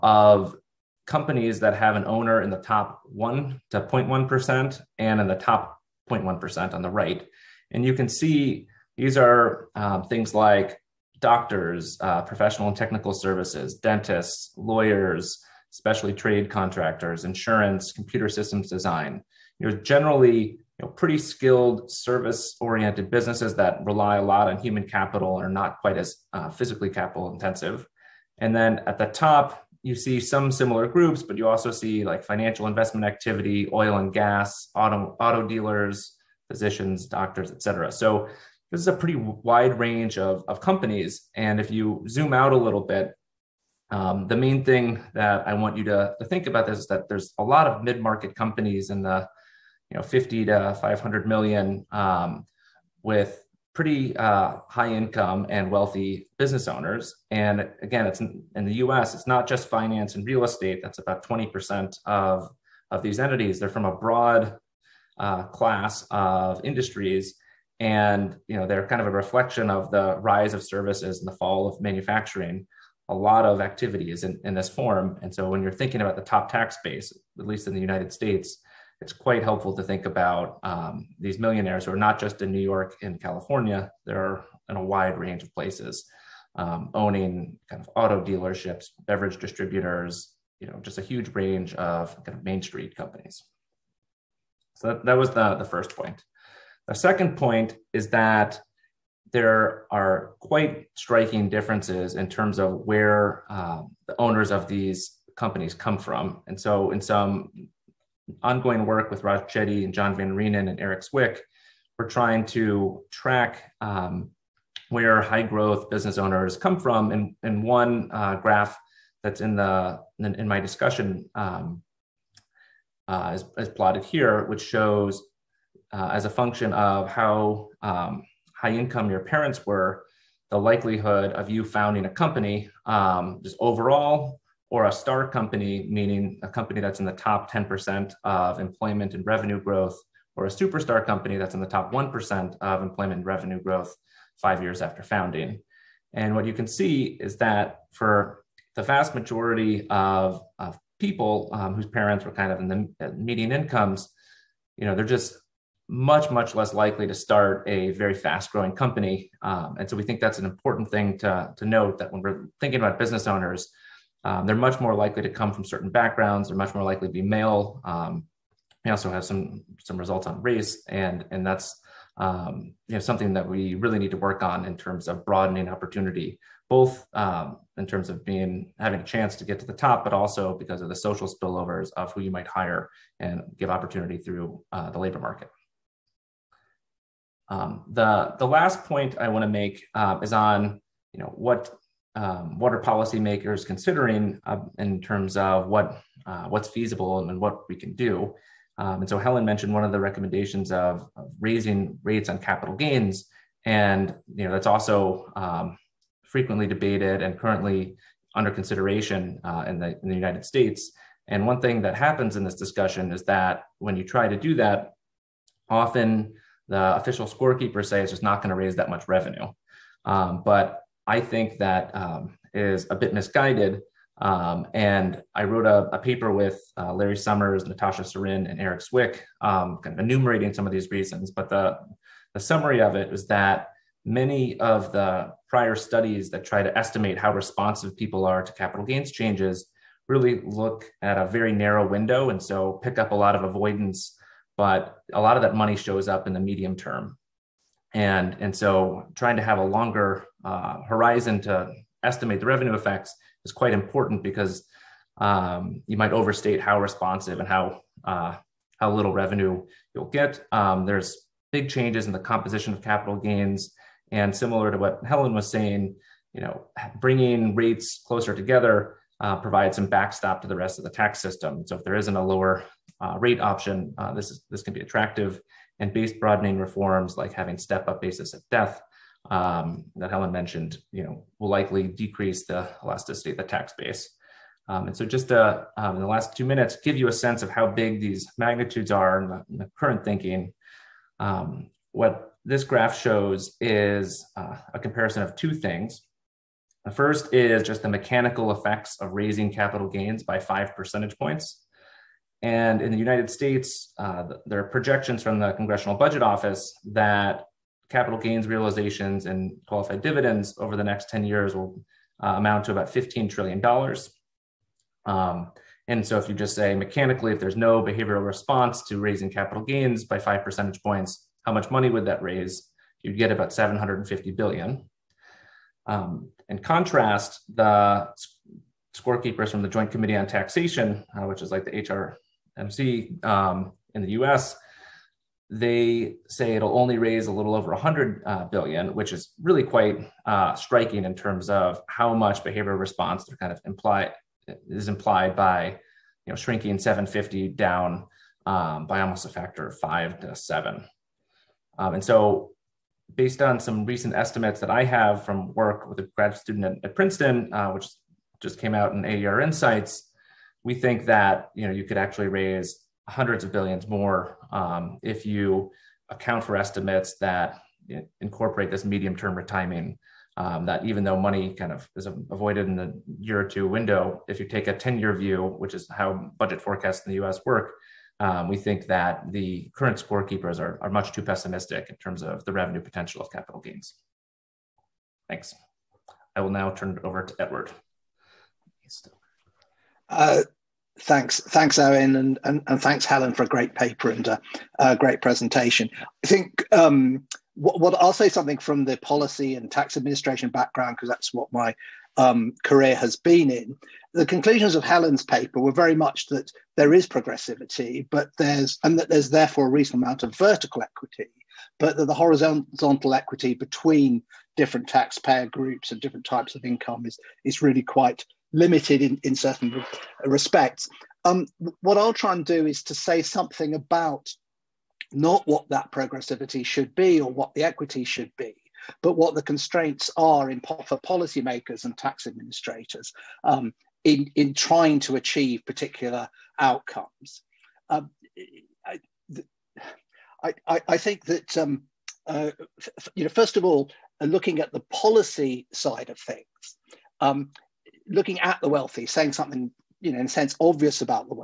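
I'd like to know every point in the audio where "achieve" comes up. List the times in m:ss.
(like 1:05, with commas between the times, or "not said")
7:15.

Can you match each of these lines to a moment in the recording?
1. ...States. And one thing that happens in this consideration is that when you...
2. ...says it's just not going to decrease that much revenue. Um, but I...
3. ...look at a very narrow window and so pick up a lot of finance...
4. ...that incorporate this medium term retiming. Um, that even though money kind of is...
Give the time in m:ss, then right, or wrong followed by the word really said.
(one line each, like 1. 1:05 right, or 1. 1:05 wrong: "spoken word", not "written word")
1. 3:30 wrong: "discussion", not "consideration"
2. 3:37 wrong: "raise", not "decrease"
3. 4:00 wrong: "avoidance", not "finance"
4. 6:07 right.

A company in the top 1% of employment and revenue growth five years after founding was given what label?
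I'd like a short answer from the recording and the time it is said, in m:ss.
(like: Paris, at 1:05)
superstar company, at 2:20.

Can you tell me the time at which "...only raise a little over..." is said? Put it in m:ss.
5:36.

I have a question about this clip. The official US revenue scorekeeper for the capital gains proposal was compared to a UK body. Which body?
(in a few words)
HRMC.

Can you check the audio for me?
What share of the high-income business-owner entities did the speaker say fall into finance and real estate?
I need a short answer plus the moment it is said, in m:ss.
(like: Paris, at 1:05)
20%, at 1:01.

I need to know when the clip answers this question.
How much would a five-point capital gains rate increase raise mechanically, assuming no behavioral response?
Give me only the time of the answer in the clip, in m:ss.
5:23.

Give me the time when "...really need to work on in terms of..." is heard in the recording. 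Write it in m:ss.
2:53.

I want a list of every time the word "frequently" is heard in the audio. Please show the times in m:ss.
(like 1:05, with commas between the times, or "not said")
3:26.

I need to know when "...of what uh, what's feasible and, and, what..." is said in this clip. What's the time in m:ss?
3:15.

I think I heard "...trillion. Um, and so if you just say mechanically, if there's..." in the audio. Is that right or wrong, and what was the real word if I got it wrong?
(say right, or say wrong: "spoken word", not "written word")
right.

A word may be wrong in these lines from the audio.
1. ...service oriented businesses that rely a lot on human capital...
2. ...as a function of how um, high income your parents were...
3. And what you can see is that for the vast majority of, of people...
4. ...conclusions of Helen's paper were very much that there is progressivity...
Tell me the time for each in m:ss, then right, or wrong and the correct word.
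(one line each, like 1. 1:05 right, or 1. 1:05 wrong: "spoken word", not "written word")
1. 0:21 right
2. 2:06 right
3. 2:26 right
4. 6:44 right.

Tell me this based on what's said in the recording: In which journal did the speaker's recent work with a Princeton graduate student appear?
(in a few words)
AER Insights.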